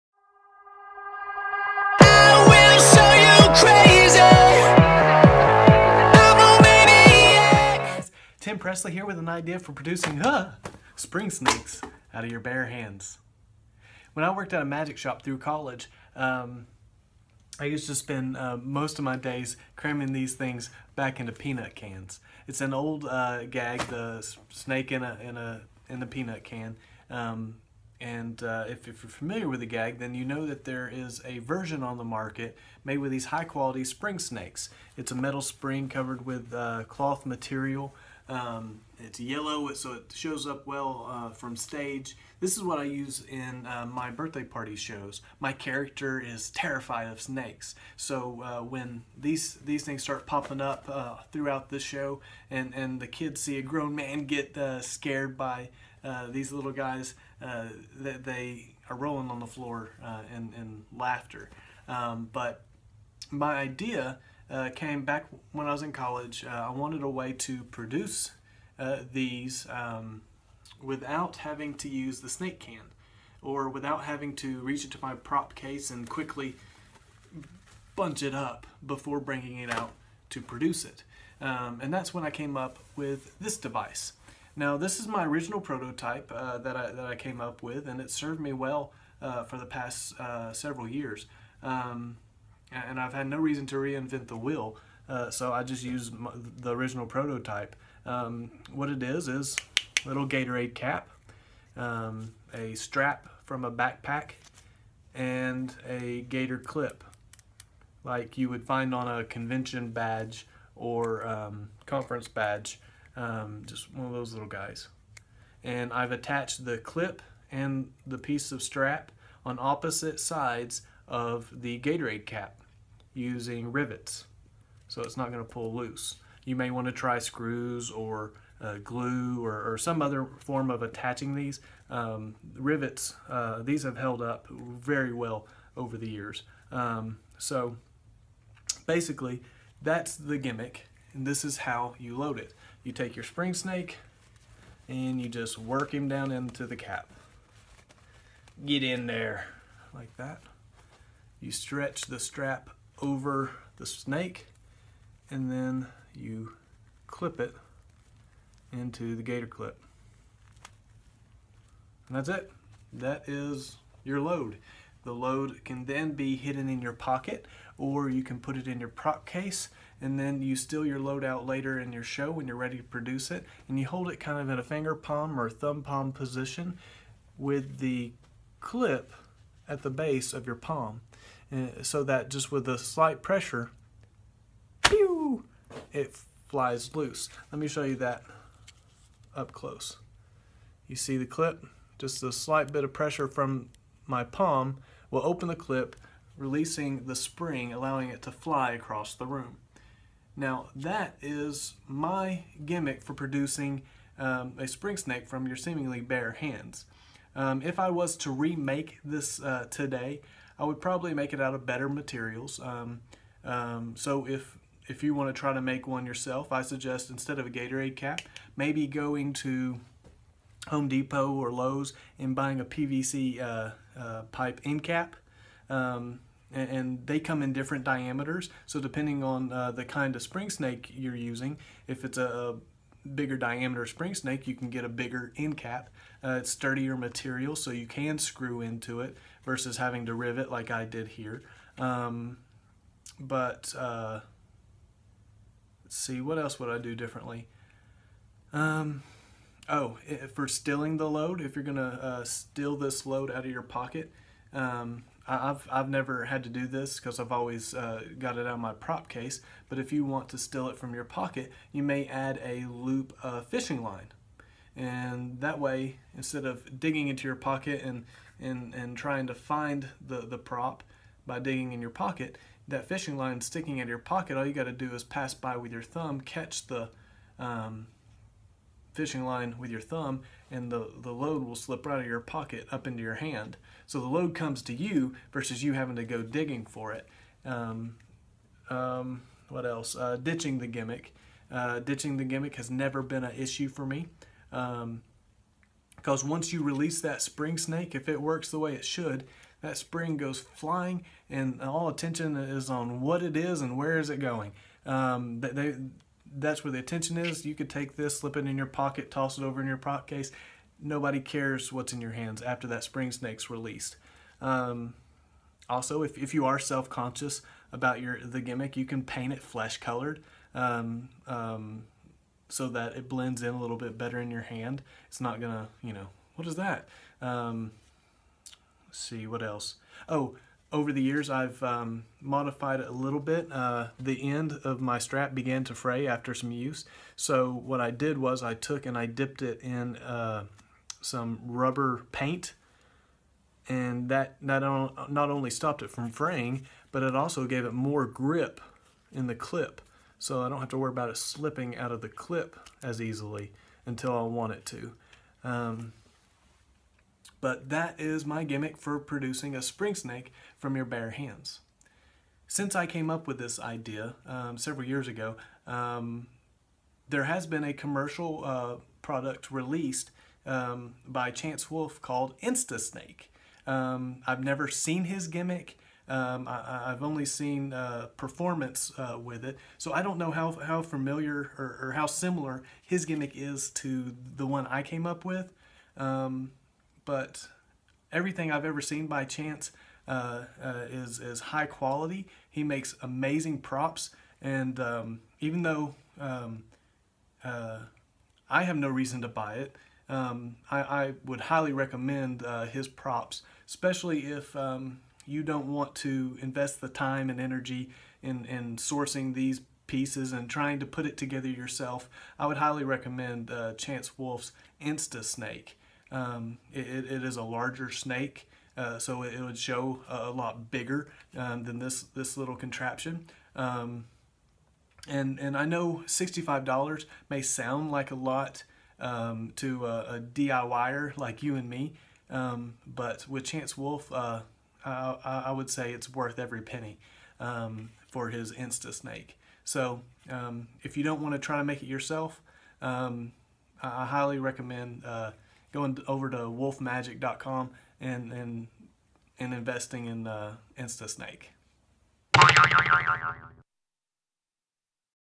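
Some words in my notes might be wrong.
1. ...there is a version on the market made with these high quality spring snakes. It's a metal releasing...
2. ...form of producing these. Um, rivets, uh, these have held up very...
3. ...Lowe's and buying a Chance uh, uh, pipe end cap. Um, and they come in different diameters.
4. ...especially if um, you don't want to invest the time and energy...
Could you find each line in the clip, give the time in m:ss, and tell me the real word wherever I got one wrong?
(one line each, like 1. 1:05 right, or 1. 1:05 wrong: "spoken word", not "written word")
1. 0:30 wrong: "spring", not "releasing"
2. 2:10 wrong: "attaching", not "producing"
3. 3:41 wrong: "PVC", not "Chance"
4. 6:43 right.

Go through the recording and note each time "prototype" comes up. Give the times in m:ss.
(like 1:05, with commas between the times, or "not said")
1:25, 1:37.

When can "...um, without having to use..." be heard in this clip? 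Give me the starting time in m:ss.
1:09.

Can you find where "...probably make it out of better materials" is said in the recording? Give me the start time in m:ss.
3:30.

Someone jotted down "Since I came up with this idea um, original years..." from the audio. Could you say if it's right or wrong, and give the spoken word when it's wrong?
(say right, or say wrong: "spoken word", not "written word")
wrong: "several", not "original".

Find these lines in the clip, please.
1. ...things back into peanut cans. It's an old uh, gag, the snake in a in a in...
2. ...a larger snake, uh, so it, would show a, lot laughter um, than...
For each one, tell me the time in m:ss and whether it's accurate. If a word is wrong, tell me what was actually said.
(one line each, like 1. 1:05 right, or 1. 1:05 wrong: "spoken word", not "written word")
1. 0:20 right
2. 6:57 wrong: "bigger", not "laughter".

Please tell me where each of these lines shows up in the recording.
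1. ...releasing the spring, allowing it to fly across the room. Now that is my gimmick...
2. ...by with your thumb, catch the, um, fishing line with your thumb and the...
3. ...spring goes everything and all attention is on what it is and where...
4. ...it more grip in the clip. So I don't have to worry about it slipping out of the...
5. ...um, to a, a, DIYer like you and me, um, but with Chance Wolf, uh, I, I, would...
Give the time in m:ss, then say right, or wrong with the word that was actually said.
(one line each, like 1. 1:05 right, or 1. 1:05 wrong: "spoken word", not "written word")
1. 3:16 right
2. 4:35 right
3. 4:59 wrong: "flying", not "everything"
4. 5:47 right
5. 7:08 right.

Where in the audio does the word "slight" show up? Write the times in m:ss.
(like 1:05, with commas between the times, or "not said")
3:02, 3:12.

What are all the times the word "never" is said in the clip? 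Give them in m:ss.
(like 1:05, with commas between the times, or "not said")
4:15, 4:52, 6:14.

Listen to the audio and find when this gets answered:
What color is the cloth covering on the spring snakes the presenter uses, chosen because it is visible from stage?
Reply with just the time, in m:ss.
0:39.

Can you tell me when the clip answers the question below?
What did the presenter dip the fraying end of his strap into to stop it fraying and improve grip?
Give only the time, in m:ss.
5:41.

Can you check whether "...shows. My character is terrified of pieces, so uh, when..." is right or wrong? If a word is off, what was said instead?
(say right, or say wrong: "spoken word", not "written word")
wrong: "snakes", not "pieces".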